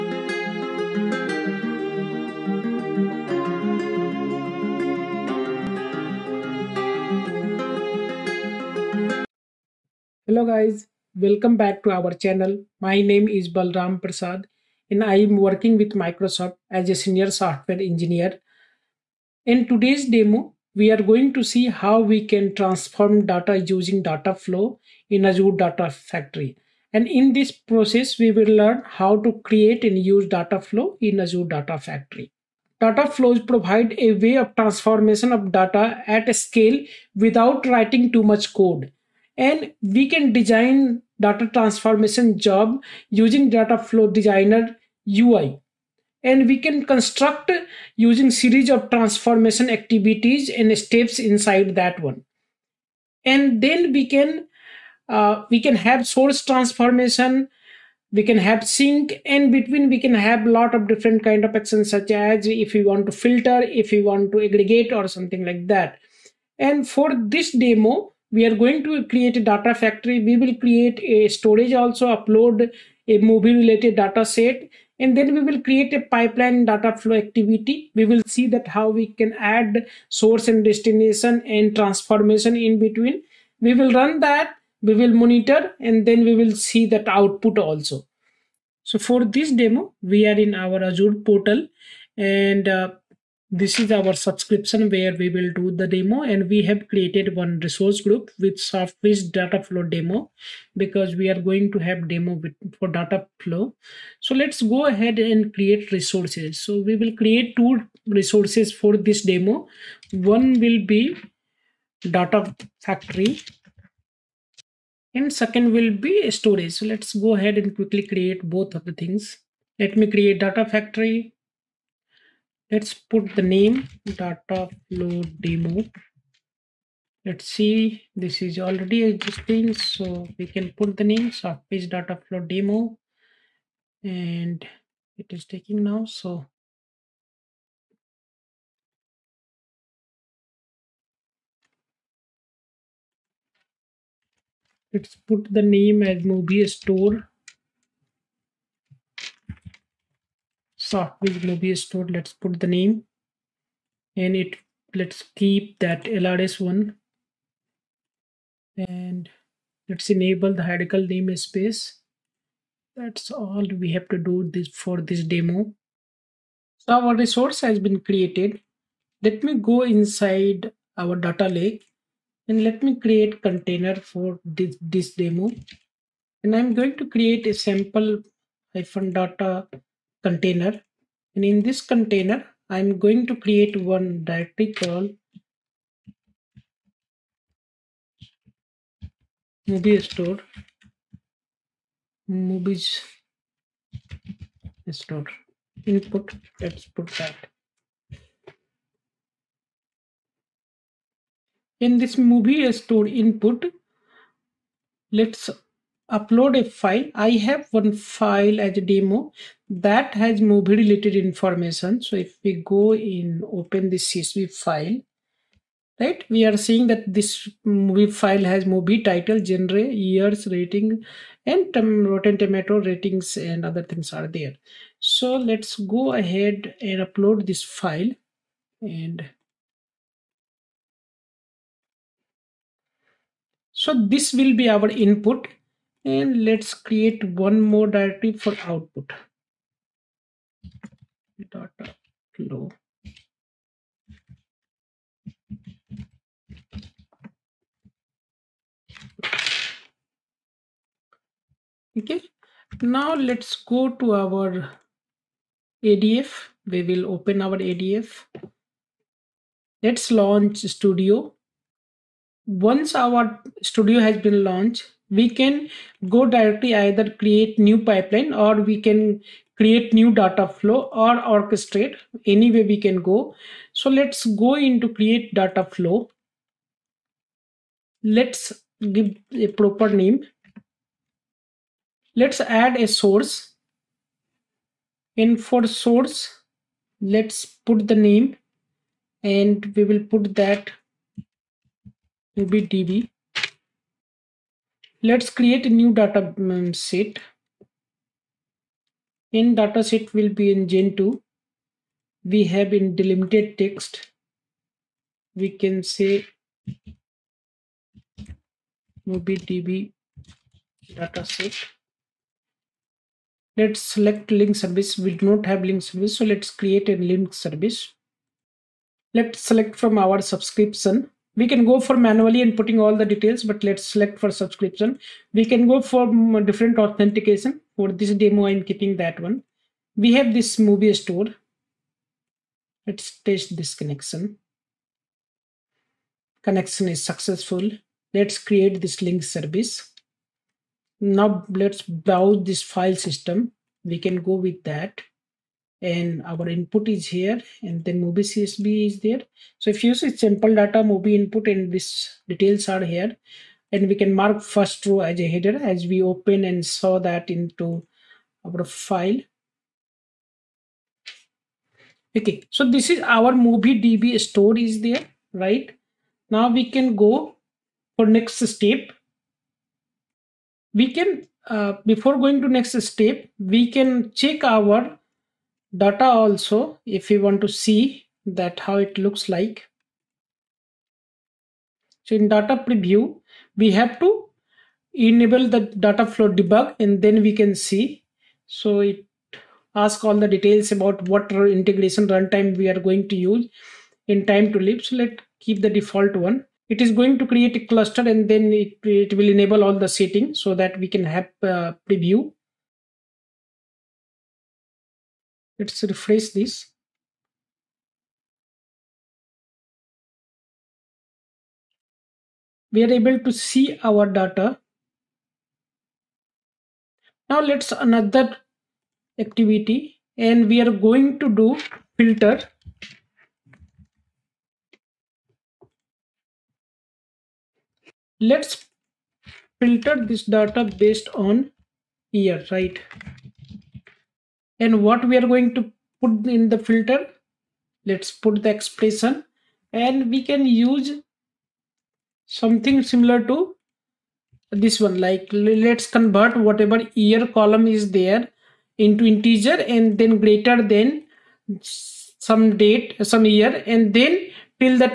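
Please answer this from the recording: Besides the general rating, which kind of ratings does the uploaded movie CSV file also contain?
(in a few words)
Rotten Tomato ratings.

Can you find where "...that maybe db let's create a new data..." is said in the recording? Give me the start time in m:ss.
4:50.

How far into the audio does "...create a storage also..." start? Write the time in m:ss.
1:10.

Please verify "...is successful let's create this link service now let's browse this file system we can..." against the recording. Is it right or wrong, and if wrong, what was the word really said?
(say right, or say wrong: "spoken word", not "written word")
right.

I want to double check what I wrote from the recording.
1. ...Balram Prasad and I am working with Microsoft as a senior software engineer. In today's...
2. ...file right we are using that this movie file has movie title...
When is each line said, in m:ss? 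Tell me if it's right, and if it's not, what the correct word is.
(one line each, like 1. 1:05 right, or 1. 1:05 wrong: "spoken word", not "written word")
1. 0:13 right
2. 3:34 wrong: "seeing", not "using".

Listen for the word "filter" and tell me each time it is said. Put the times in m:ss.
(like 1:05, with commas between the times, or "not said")
1:03, 7:02, 7:09, 7:16.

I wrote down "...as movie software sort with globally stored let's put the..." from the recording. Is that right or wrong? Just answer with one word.
wrong.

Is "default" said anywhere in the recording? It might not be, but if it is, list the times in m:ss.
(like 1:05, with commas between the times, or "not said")
6:35.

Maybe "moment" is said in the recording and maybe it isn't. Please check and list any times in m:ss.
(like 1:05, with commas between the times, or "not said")
not said.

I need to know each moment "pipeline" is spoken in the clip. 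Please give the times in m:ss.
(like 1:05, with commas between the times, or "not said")
1:16, 4:27.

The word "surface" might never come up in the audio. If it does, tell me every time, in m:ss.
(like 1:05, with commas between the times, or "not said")
1:38, 2:11.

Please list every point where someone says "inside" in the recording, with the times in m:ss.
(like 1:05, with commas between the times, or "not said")
0:51, 2:49.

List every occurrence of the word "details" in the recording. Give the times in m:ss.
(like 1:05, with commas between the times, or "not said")
5:23, 5:52, 6:30.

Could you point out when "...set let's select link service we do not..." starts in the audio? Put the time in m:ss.
5:11.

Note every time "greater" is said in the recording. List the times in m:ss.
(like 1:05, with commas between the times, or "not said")
7:30.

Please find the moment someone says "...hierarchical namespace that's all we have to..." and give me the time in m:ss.
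2:40.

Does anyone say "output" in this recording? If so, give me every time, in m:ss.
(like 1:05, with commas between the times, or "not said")
1:27, 3:58.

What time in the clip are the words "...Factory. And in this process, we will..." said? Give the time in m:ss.
0:25.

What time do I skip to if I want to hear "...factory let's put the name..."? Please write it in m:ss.
2:00.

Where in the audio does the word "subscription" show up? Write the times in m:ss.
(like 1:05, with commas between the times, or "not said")
1:34, 5:20, 5:24.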